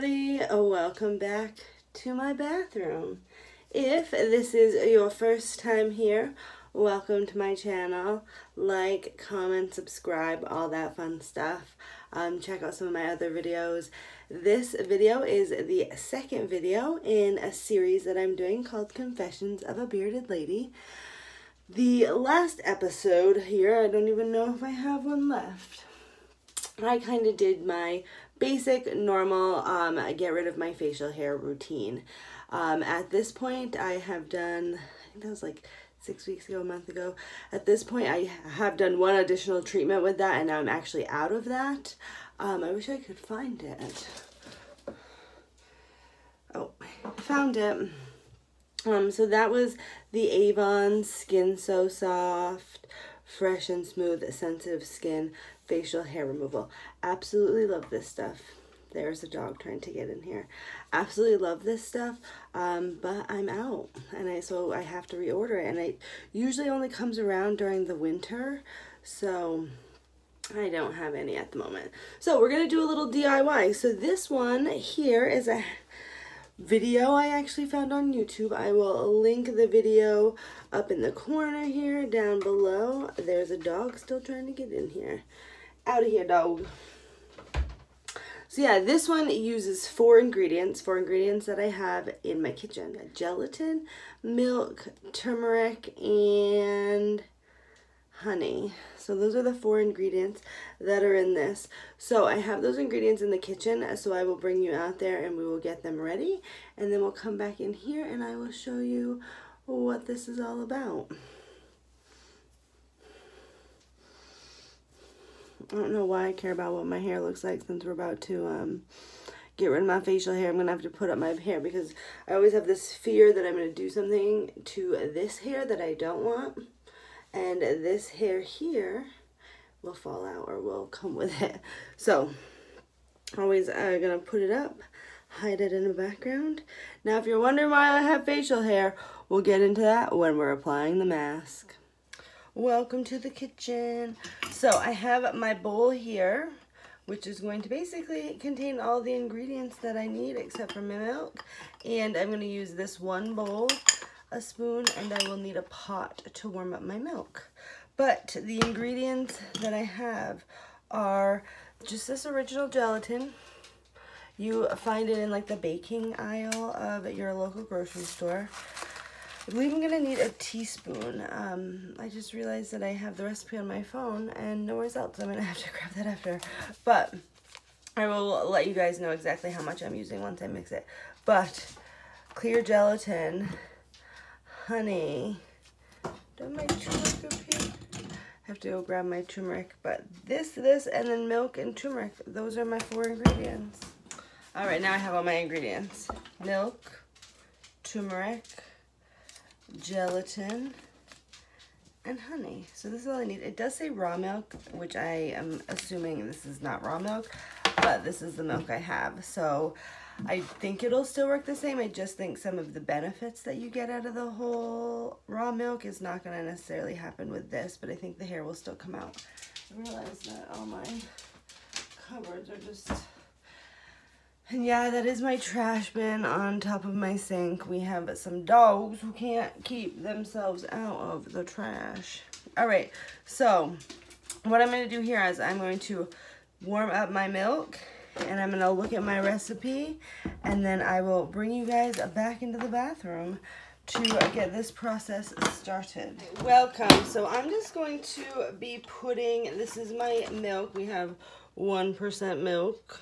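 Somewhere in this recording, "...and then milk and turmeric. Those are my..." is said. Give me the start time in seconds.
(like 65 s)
190 s.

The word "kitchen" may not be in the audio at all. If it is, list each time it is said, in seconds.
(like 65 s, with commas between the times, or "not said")
92 s, 103 s, 143 s.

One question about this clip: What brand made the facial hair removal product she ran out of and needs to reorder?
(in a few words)
Avon.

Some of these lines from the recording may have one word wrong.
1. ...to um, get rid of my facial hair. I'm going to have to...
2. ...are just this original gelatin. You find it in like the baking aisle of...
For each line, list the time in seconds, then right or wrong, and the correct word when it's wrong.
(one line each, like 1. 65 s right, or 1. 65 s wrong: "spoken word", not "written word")
1. 118 s right
2. 160 s right.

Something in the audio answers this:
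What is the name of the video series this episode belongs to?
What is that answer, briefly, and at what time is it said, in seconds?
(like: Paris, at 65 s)
Confessions of a Bearded Lady, at 18 s.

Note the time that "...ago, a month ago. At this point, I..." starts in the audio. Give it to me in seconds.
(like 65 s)
36 s.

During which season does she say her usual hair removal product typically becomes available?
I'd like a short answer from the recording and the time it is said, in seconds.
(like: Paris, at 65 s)
winter, at 67 s.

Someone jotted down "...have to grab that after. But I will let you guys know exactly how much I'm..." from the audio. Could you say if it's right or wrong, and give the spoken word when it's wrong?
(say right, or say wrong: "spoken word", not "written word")
right.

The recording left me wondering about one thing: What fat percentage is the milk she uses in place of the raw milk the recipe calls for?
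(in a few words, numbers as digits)
1%.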